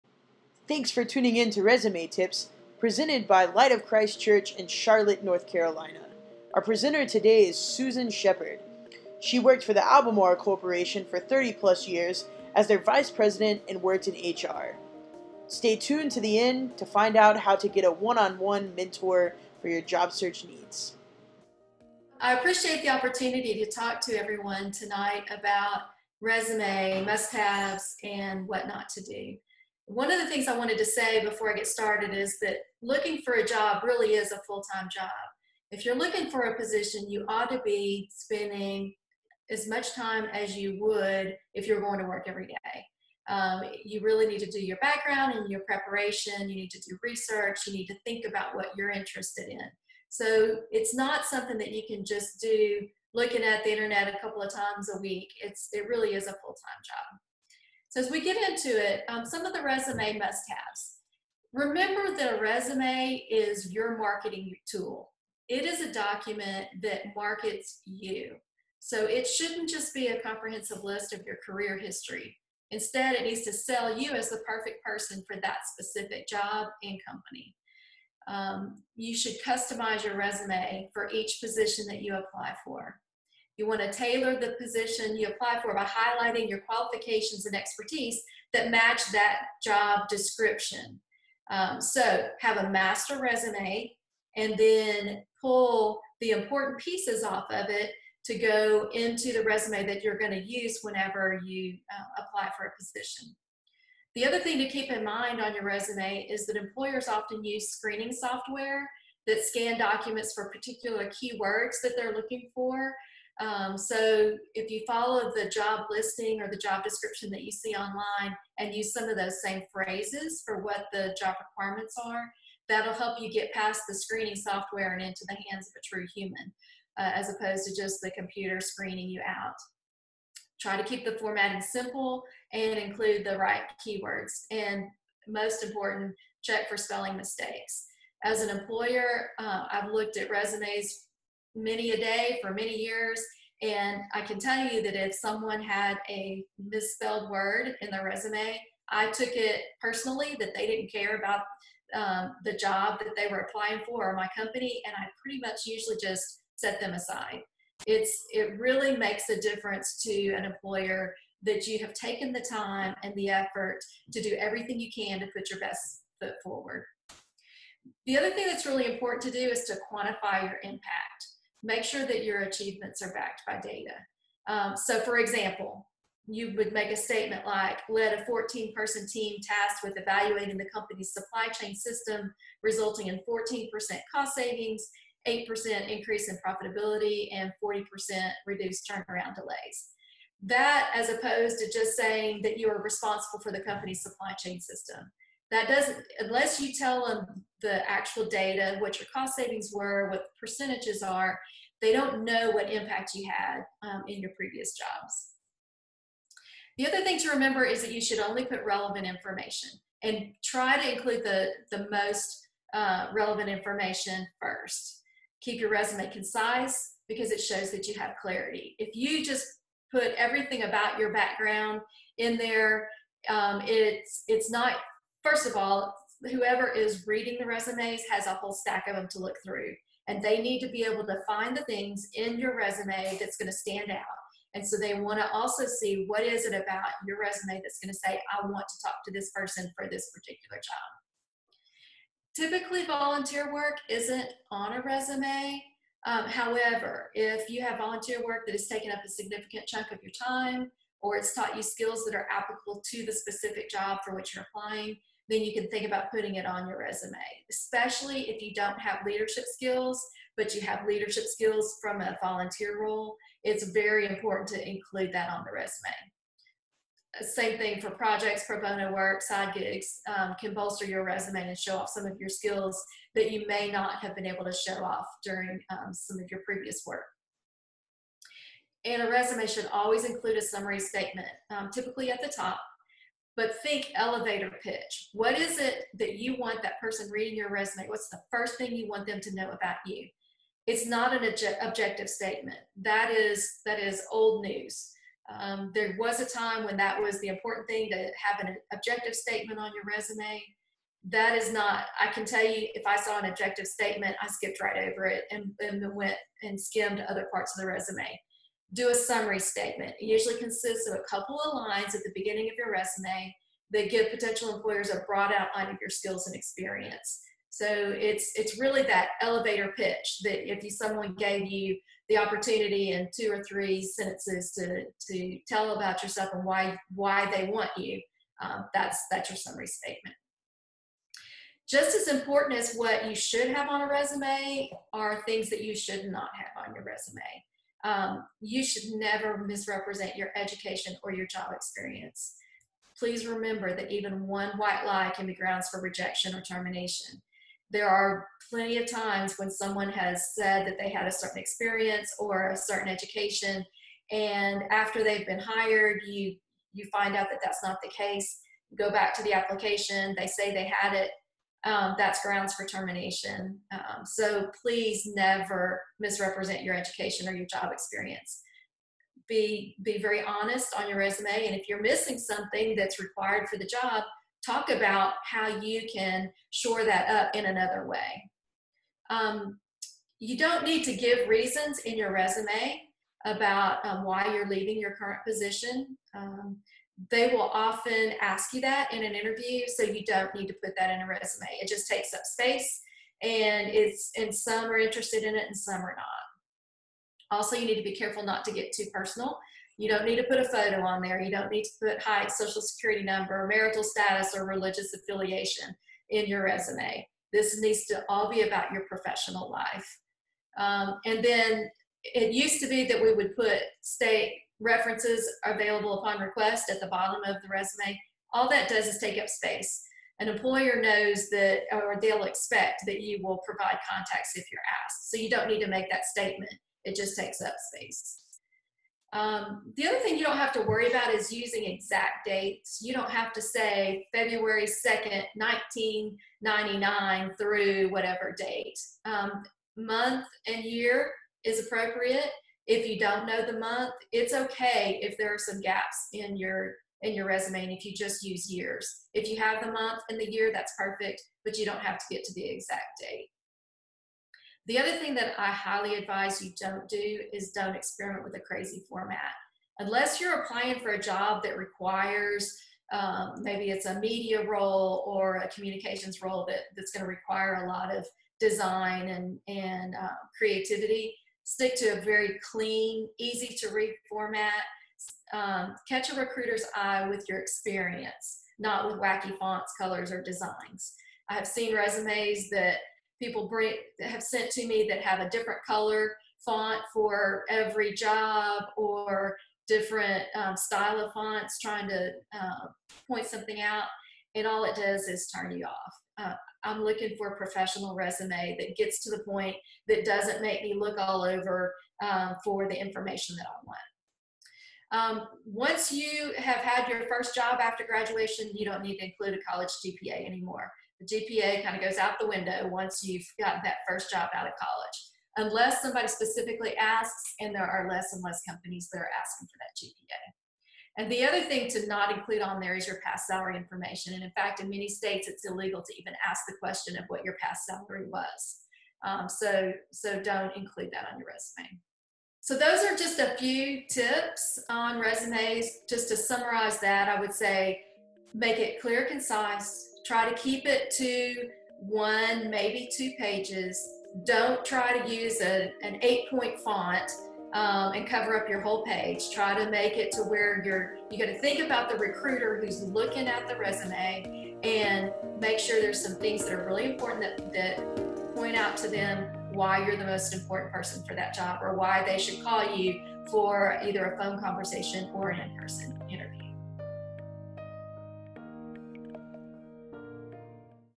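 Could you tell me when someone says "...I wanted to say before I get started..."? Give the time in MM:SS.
00:30.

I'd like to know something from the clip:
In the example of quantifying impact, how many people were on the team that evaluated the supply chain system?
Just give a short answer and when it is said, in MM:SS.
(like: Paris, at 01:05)
14, at 02:58.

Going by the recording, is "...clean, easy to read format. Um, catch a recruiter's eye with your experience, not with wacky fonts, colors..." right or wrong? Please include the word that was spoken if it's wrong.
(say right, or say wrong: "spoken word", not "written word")
right.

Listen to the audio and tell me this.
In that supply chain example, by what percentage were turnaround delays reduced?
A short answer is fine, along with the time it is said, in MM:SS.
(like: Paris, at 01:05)
40%, at 03:07.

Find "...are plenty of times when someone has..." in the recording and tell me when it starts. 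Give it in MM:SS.
05:47.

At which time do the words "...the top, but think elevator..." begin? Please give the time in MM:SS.
04:42.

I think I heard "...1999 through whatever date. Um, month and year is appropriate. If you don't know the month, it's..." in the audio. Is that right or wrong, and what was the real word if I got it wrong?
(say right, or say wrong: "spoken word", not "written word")
right.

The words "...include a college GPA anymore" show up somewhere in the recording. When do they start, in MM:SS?
08:29.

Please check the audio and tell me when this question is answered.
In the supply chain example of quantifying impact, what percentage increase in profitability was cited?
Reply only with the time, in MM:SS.
03:05.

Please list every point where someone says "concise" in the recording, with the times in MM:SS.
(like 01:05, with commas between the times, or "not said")
03:36, 08:59.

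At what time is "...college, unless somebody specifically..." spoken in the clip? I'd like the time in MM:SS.
08:34.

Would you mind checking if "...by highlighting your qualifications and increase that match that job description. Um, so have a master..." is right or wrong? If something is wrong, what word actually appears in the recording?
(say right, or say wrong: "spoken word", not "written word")
wrong: "expertise", not "increase".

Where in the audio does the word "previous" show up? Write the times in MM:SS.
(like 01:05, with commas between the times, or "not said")
03:24, 04:36.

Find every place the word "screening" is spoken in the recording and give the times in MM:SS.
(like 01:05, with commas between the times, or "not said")
01:47, 02:03, 02:08.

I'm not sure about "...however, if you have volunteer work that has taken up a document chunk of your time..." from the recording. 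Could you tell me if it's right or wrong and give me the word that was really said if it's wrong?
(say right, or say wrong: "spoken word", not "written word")
wrong: "significant", not "document".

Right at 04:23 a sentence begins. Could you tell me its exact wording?
It's very important to include that on the resume.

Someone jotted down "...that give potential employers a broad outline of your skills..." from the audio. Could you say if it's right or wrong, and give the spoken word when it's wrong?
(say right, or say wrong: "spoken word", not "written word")
right.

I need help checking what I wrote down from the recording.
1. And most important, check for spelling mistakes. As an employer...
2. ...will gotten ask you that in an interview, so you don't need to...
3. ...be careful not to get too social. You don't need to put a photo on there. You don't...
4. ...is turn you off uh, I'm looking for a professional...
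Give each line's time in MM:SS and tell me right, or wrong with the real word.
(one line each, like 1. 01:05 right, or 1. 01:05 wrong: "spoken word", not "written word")
1. 02:14 right
2. 06:27 wrong: "often", not "gotten"
3. 06:37 wrong: "personal", not "social"
4. 08:15 right.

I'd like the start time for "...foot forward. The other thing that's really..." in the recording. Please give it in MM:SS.
02:46.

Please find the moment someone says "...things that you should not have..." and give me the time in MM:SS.
05:35.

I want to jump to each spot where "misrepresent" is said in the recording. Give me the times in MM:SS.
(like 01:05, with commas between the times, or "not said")
05:39, 06:05.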